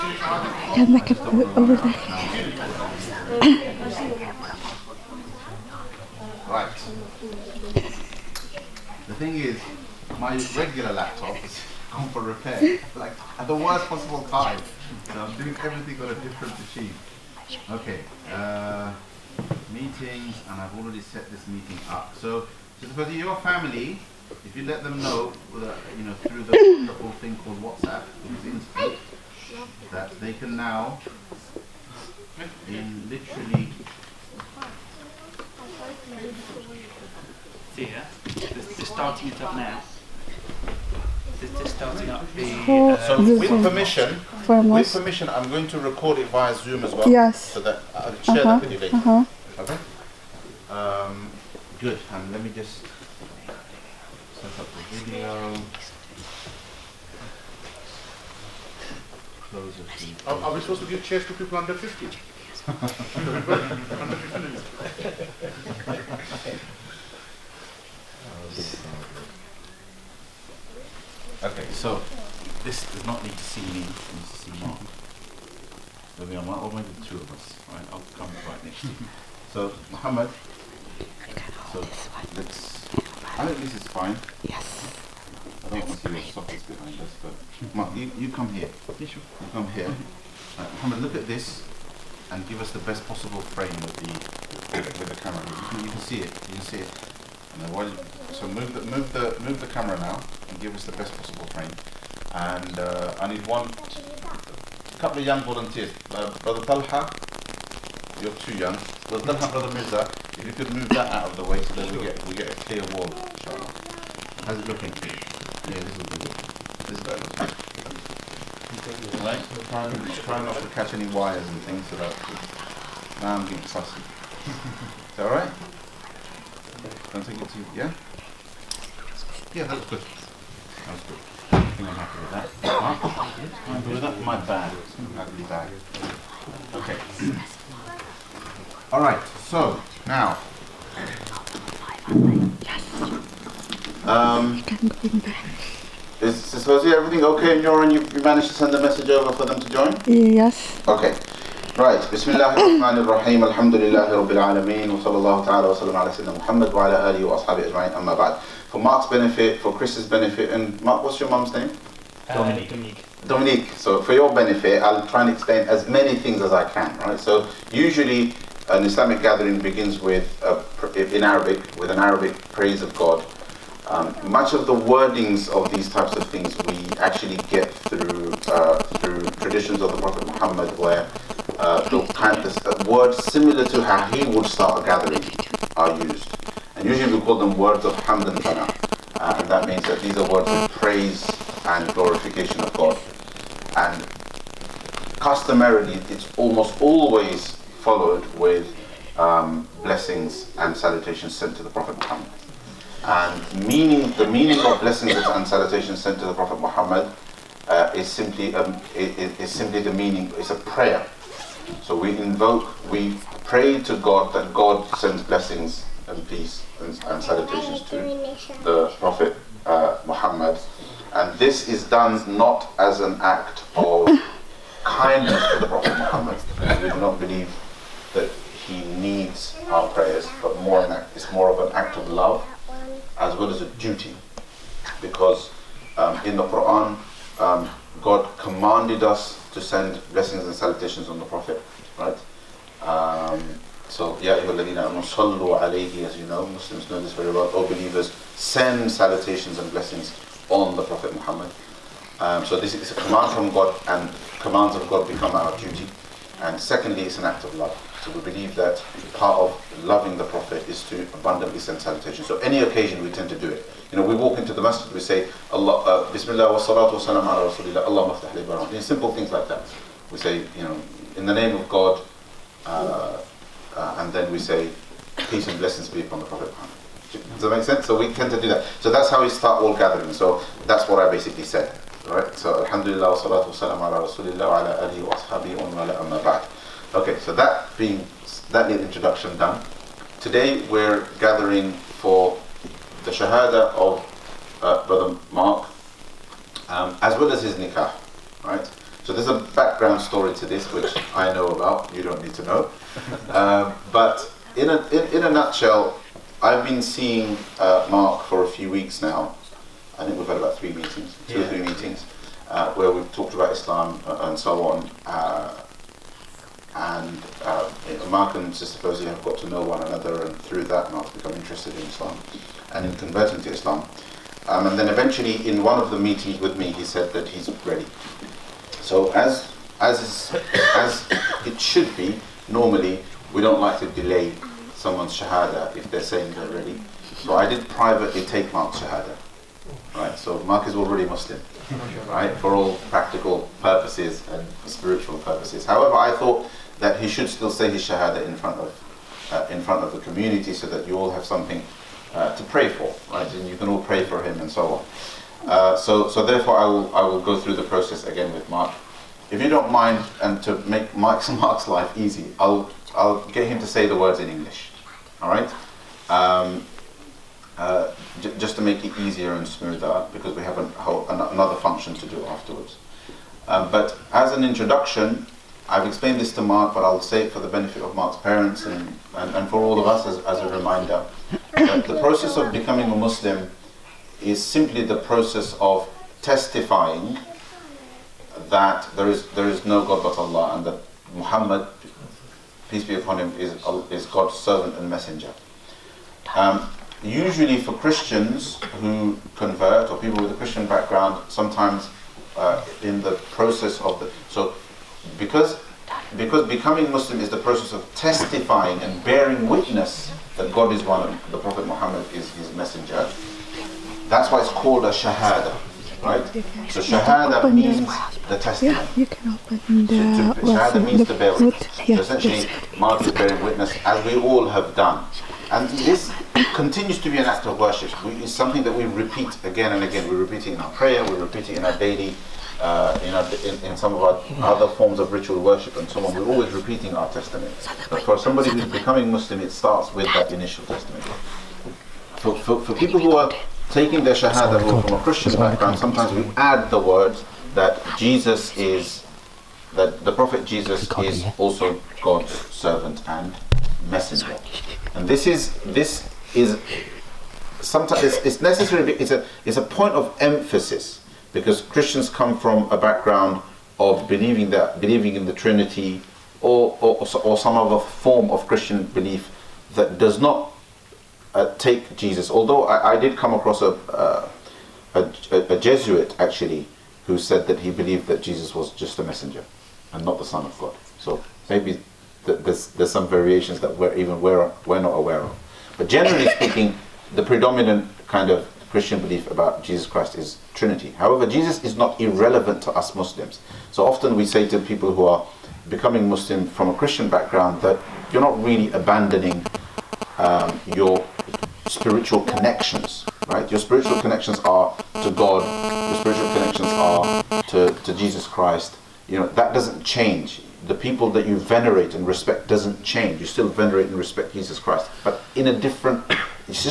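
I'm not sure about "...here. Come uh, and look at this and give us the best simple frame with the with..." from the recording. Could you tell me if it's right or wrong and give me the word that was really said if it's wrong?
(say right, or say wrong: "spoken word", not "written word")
wrong: "possible", not "simple".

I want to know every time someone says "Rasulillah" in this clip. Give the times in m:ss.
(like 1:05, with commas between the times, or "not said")
4:27, 4:44.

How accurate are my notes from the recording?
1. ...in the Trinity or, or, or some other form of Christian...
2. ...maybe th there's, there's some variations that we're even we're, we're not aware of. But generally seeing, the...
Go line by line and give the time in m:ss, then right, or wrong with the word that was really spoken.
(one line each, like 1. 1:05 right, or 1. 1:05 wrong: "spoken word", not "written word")
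1. 7:45 right
2. 8:01 wrong: "speaking", not "seeing".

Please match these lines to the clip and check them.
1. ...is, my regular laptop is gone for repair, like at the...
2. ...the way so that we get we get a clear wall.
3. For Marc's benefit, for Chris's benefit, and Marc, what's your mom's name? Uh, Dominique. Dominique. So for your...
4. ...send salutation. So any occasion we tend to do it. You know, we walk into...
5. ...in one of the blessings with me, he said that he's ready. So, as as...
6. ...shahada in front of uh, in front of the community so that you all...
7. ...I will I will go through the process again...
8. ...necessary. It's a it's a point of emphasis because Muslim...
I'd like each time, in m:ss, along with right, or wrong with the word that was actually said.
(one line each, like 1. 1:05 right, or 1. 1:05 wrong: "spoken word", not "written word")
1. 0:09 right
2. 1:51 right
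3. 2:38 right
4. 4:21 right
5. 5:25 wrong: "meetings", not "blessings"
6. 5:47 right
7. 5:56 right
8. 7:38 wrong: "Christians", not "Muslim".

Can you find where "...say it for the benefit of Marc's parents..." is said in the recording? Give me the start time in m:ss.
6:17.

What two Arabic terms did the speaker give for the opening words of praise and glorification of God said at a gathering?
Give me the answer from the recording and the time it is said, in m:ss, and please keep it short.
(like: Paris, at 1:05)
hamd and thana, at 3:08.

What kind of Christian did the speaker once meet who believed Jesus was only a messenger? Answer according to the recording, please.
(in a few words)
Jesuit.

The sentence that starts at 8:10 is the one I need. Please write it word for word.
However, Jesus is not irrelevant to us Muslims.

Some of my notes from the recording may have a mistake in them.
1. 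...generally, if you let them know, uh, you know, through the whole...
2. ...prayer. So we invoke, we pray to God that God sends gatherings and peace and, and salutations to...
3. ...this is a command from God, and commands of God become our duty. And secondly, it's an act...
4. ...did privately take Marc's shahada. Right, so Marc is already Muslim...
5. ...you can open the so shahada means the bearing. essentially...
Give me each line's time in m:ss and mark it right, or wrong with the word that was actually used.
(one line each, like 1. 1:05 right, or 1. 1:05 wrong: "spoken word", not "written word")
1. 0:23 wrong: "family", not "generally"
2. 3:30 wrong: "blessings", not "gatherings"
3. 4:12 right
4. 5:37 right
5. 6:58 right.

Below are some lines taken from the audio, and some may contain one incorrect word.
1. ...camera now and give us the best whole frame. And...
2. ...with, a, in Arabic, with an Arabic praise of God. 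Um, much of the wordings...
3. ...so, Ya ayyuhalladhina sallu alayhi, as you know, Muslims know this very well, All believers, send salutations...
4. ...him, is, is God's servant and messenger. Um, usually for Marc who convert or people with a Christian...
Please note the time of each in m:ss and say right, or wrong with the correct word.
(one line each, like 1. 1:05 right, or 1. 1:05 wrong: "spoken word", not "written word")
1. 1:39 wrong: "possible", not "whole"
2. 2:50 right
3. 4:03 right
4. 6:33 wrong: "Christians", not "Marc".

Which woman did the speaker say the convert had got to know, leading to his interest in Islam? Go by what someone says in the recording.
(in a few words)
Fozia.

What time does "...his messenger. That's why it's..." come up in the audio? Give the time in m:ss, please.
6:52.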